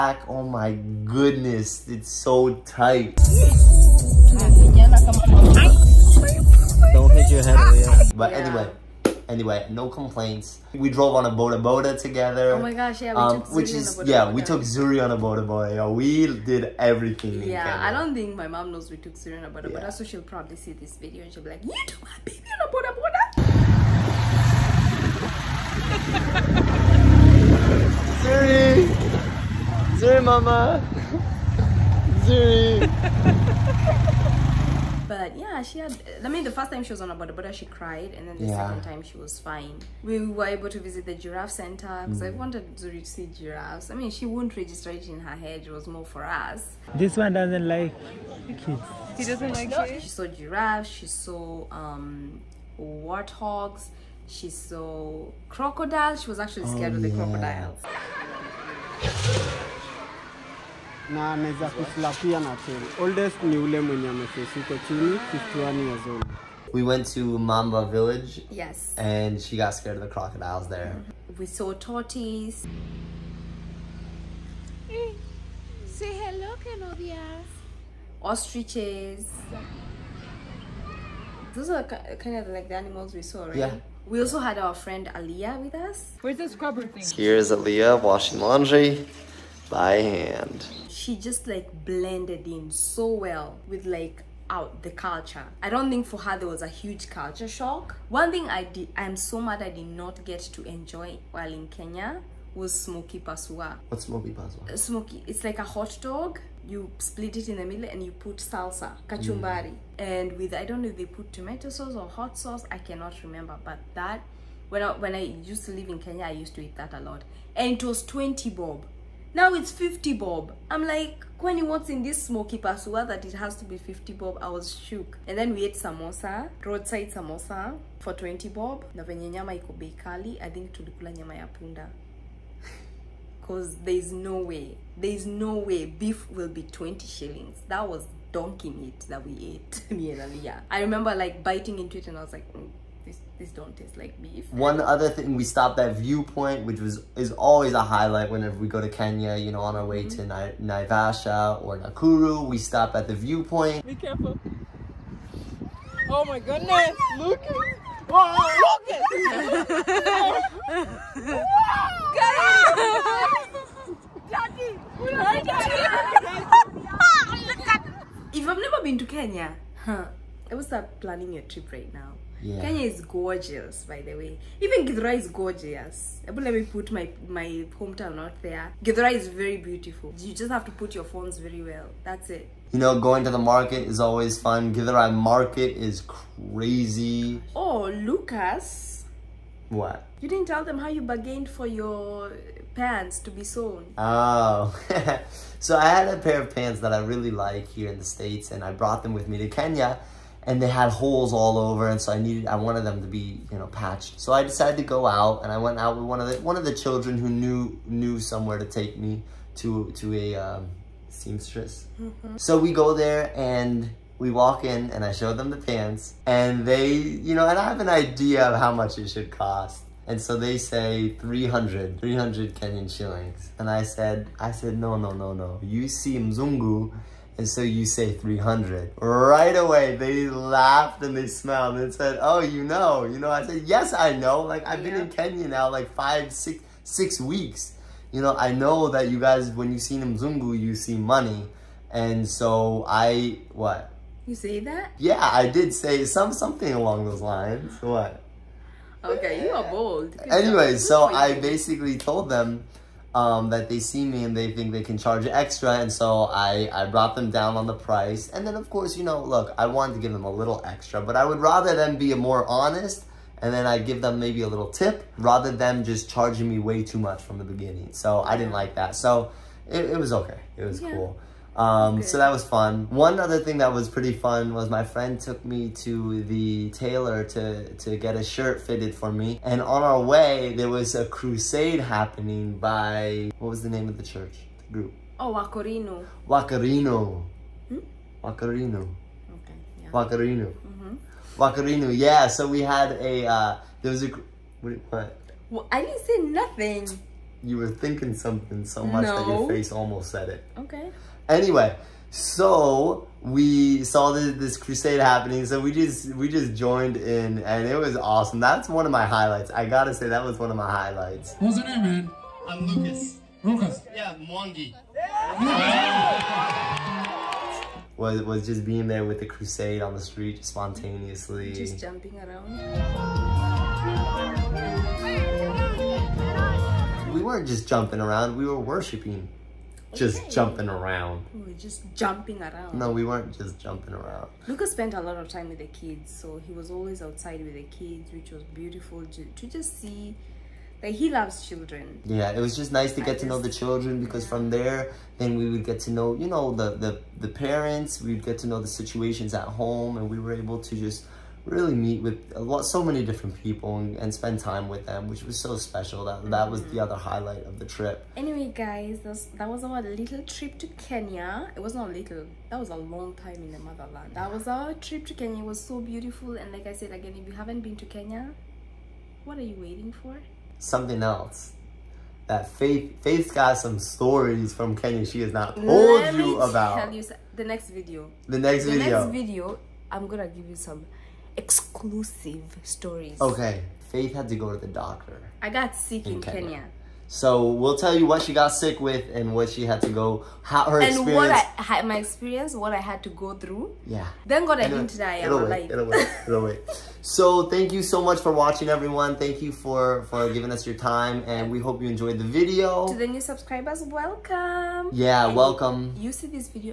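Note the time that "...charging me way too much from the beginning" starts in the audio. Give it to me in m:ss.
4:26.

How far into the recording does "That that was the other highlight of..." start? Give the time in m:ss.
5:56.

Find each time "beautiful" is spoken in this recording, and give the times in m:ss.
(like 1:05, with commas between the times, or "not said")
2:59, 5:38, 6:05.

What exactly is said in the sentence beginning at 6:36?
So thank you so much for watching, everyone.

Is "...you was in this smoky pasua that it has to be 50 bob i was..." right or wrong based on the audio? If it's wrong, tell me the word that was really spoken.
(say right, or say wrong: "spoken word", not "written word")
right.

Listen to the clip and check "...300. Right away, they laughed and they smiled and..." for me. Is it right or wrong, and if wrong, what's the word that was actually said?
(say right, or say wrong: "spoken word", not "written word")
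right.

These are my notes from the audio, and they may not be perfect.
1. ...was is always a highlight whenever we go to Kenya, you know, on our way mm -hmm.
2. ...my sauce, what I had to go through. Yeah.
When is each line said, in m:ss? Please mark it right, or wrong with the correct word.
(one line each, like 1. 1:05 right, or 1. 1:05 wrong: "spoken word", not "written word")
1. 2:26 right
2. 6:31 wrong: "experience", not "sauce".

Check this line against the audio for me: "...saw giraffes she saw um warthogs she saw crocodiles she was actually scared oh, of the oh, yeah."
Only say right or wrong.
right.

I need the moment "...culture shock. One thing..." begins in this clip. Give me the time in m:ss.
1:37.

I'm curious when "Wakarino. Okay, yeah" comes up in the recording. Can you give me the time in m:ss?
4:48.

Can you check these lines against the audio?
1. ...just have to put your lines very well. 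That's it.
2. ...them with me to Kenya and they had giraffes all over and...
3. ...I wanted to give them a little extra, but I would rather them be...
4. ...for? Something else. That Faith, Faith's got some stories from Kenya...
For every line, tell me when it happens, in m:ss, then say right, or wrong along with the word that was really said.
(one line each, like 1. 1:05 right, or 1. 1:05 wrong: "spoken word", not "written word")
1. 3:00 wrong: "phones", not "lines"
2. 3:19 wrong: "holes", not "giraffes"
3. 4:19 right
4. 6:10 right.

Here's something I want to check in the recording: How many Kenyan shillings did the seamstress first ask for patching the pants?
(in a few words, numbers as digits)
300.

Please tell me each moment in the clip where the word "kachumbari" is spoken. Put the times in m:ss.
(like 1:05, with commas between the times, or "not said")
1:49.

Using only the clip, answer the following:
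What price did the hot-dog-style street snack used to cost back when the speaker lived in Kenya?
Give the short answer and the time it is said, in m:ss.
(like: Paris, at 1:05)
20 bob, at 1:57.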